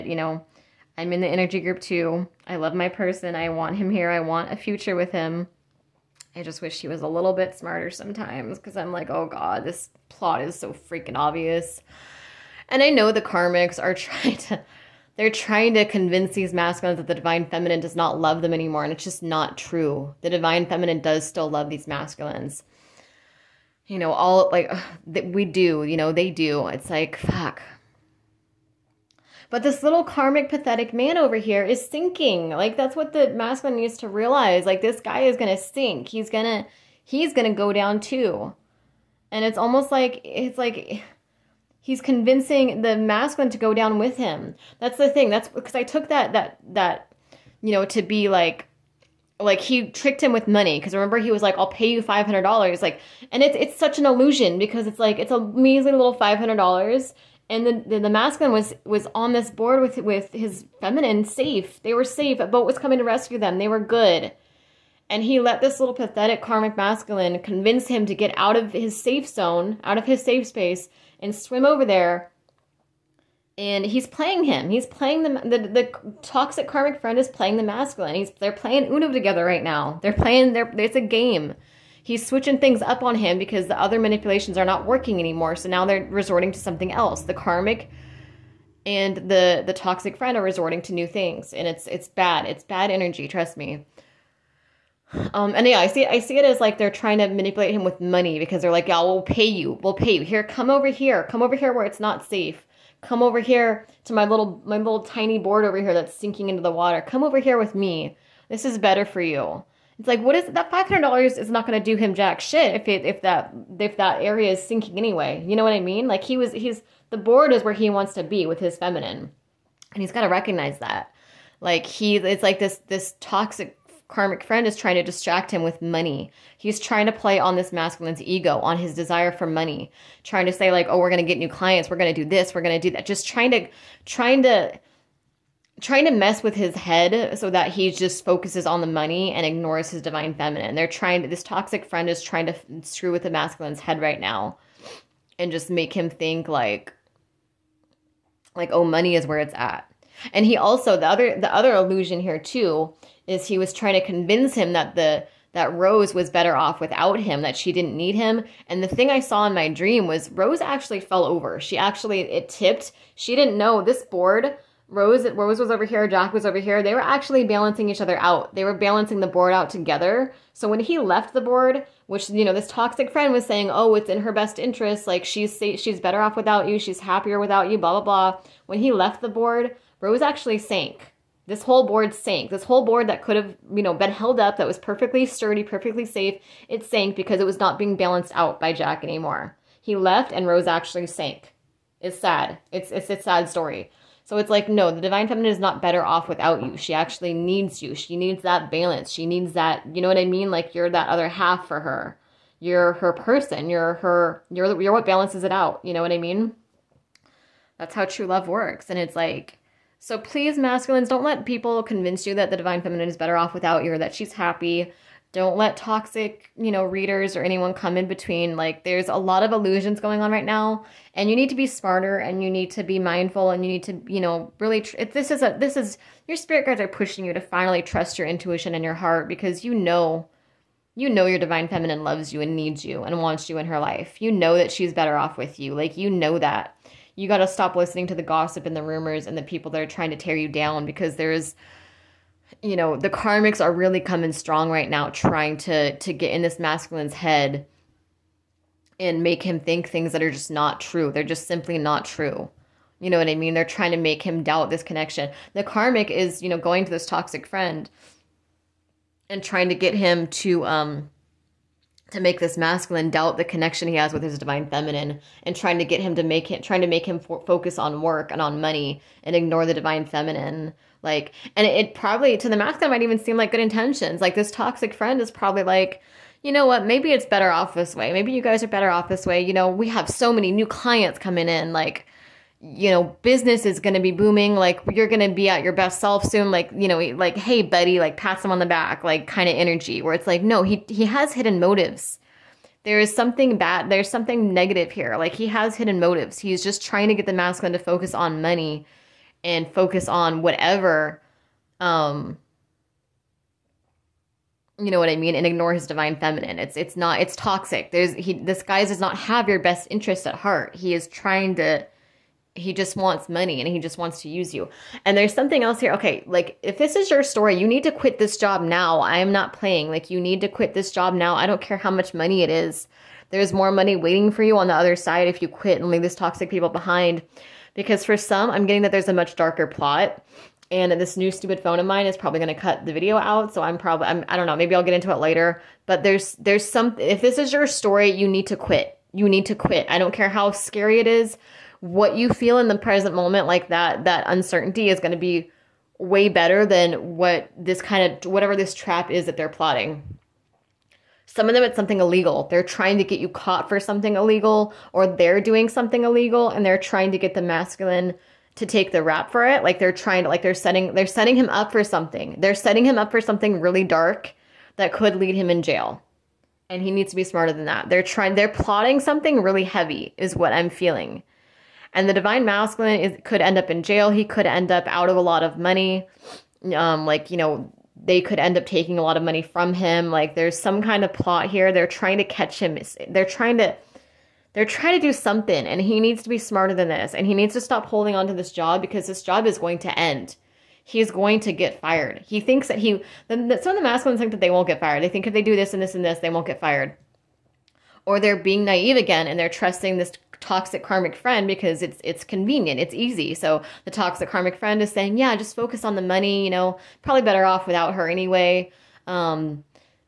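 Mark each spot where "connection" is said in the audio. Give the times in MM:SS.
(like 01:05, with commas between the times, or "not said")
04:14, 04:23.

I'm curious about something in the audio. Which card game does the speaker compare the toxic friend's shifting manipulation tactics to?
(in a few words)
Uno.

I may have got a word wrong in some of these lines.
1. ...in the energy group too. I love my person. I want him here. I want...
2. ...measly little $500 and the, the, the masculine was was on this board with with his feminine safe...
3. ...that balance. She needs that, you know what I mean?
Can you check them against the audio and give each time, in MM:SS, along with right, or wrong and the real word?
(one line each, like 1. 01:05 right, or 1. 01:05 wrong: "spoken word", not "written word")
1. 00:01 right
2. 00:55 right
3. 03:18 right.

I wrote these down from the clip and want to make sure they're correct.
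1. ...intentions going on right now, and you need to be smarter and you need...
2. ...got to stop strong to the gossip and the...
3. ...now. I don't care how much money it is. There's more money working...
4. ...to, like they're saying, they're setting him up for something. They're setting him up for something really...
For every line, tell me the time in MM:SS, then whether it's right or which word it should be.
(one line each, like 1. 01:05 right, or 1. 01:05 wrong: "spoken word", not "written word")
1. 03:39 wrong: "illusions", not "intentions"
2. 03:57 wrong: "listening", not "strong"
3. 05:21 wrong: "waiting", not "working"
4. 06:00 wrong: "setting", not "saying".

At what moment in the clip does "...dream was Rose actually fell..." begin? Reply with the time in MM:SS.
02:39.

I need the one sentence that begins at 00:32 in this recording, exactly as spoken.
Like that's what the masculine needs to realize.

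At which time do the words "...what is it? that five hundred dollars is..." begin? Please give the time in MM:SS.
01:50.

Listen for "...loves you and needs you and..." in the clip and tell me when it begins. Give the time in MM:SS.
03:52.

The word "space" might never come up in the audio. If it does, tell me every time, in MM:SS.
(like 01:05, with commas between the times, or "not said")
01:10.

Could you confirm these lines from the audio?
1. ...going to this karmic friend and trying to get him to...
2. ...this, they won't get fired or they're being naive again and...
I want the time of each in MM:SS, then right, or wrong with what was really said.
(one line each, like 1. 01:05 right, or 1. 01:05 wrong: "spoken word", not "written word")
1. 04:16 wrong: "toxic", not "karmic"
2. 06:36 right.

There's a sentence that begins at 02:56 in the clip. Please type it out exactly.
She's happier without you." Blah blah blah.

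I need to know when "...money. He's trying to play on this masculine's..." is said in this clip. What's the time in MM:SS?
02:05.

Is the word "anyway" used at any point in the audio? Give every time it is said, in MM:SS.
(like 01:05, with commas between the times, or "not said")
01:54, 06:48.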